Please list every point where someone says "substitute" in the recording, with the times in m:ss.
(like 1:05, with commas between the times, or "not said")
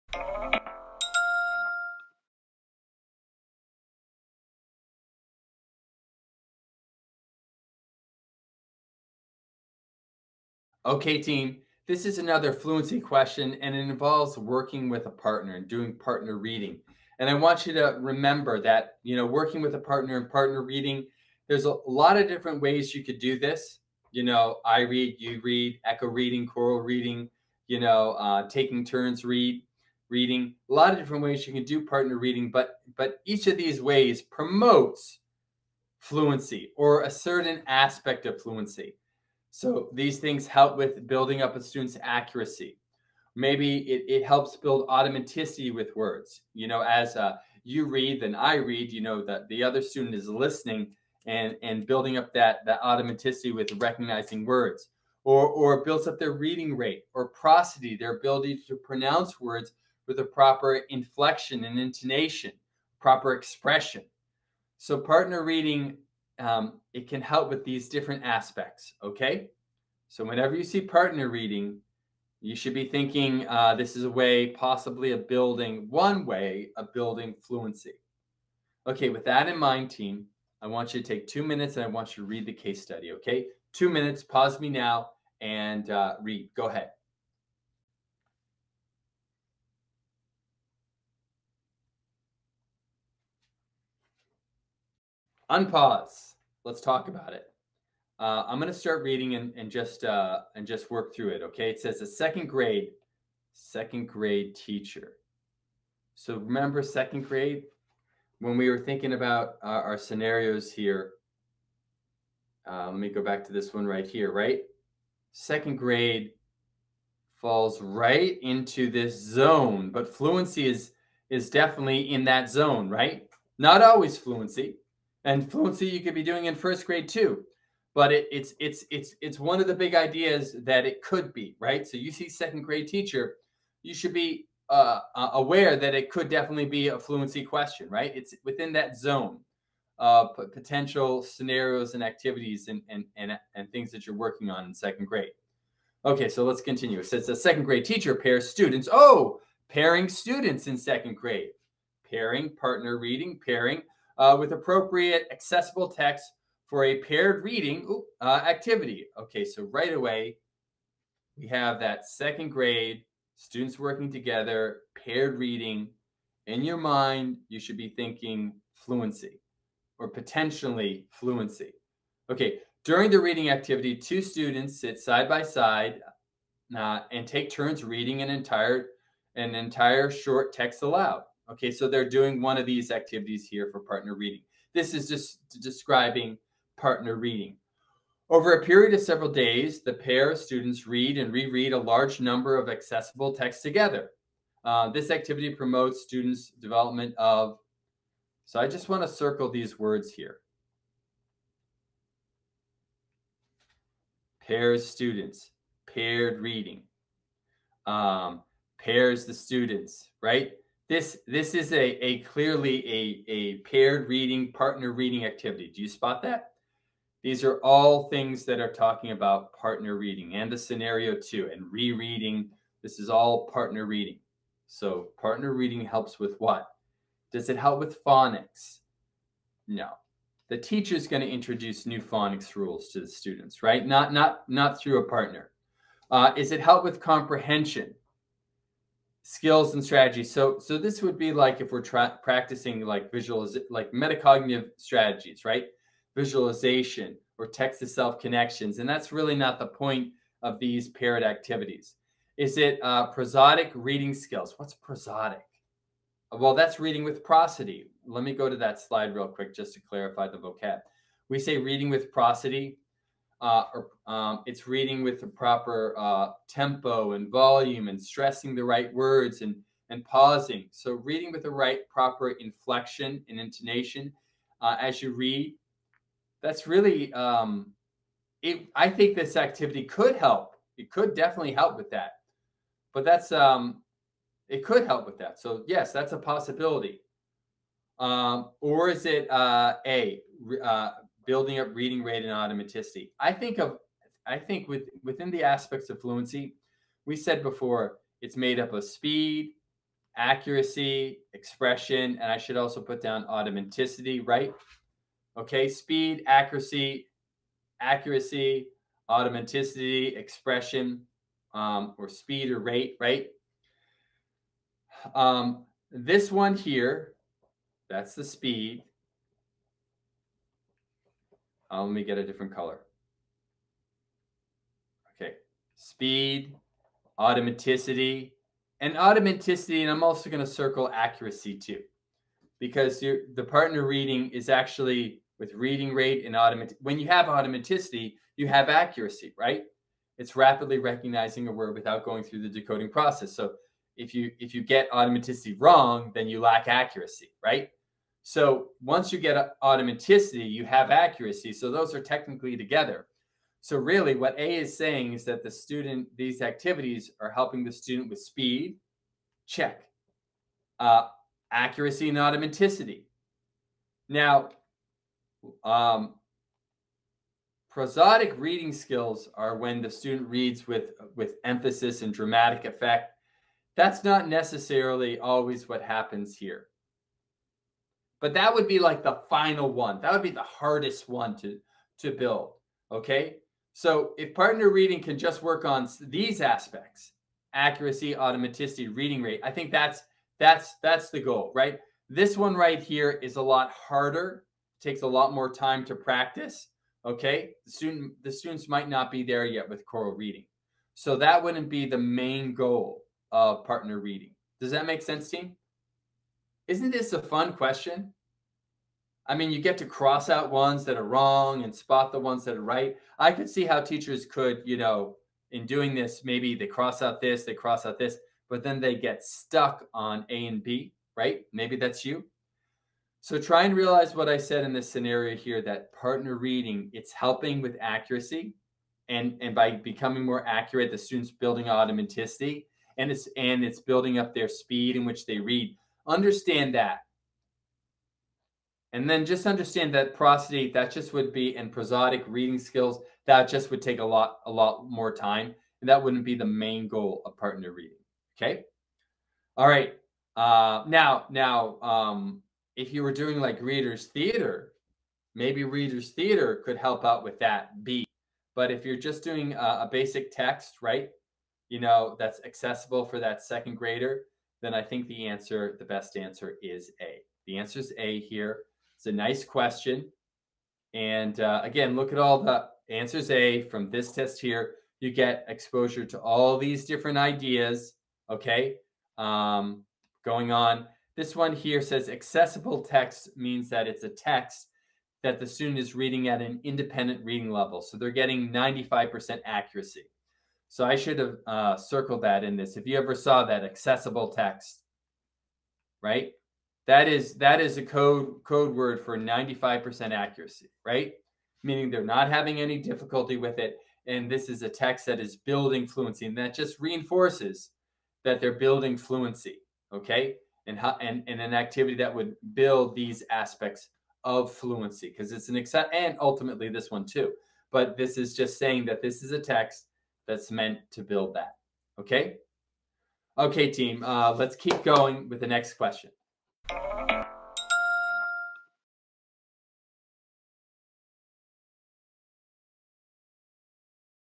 not said.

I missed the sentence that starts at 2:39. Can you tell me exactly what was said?
Okay, so right away, we have that second grade, students working together, paired reading.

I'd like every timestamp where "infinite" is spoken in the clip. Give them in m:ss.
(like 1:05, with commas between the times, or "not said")
not said.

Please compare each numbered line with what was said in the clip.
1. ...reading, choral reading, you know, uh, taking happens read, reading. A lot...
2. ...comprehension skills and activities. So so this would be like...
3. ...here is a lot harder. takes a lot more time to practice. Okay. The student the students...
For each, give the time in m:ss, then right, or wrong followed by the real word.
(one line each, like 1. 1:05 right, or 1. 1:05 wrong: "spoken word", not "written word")
1. 0:26 wrong: "turns", not "happens"
2. 3:56 wrong: "strategies", not "activities"
3. 6:32 right.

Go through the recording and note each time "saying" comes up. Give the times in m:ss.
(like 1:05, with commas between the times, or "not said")
5:54, 8:38.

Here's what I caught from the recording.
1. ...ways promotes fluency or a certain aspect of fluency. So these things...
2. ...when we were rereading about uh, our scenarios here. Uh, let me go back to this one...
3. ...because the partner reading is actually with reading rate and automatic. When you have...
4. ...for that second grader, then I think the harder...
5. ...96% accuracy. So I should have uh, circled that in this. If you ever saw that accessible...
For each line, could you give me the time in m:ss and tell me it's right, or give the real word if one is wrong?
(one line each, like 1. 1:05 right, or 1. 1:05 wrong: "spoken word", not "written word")
1. 0:33 right
2. 1:48 wrong: "thinking", not "rereading"
3. 5:32 right
4. 7:43 wrong: "answer", not "harder"
5. 8:08 wrong: "95", not "96".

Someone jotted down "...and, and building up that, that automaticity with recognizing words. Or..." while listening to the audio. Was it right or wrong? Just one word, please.
right.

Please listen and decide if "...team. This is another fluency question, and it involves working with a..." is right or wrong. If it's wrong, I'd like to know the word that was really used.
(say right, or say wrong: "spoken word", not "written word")
right.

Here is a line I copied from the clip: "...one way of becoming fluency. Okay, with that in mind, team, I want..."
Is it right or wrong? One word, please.
wrong.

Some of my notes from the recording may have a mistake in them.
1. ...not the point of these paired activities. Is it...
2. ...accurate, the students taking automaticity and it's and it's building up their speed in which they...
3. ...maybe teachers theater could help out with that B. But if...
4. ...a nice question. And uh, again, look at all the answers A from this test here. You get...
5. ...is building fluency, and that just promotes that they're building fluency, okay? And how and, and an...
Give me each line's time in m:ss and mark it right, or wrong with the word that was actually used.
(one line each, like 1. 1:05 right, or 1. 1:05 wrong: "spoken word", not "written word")
1. 4:09 right
2. 7:10 wrong: "building", not "taking"
3. 7:35 wrong: "readers", not "teachers"
4. 7:49 right
5. 8:25 wrong: "reinforces", not "promotes".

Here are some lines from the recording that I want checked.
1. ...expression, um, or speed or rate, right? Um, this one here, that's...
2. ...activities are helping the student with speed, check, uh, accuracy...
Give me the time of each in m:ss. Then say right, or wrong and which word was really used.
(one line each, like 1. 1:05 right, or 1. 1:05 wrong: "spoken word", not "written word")
1. 5:10 right
2. 5:56 right.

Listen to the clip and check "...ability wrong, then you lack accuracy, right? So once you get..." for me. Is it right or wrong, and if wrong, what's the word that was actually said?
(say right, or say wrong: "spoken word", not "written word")
wrong: "automaticity", not "ability".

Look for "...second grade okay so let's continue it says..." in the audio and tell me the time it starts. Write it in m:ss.
2:24.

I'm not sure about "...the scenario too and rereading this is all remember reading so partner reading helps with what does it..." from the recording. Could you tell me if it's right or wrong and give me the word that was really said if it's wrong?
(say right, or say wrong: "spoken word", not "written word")
wrong: "partner", not "remember".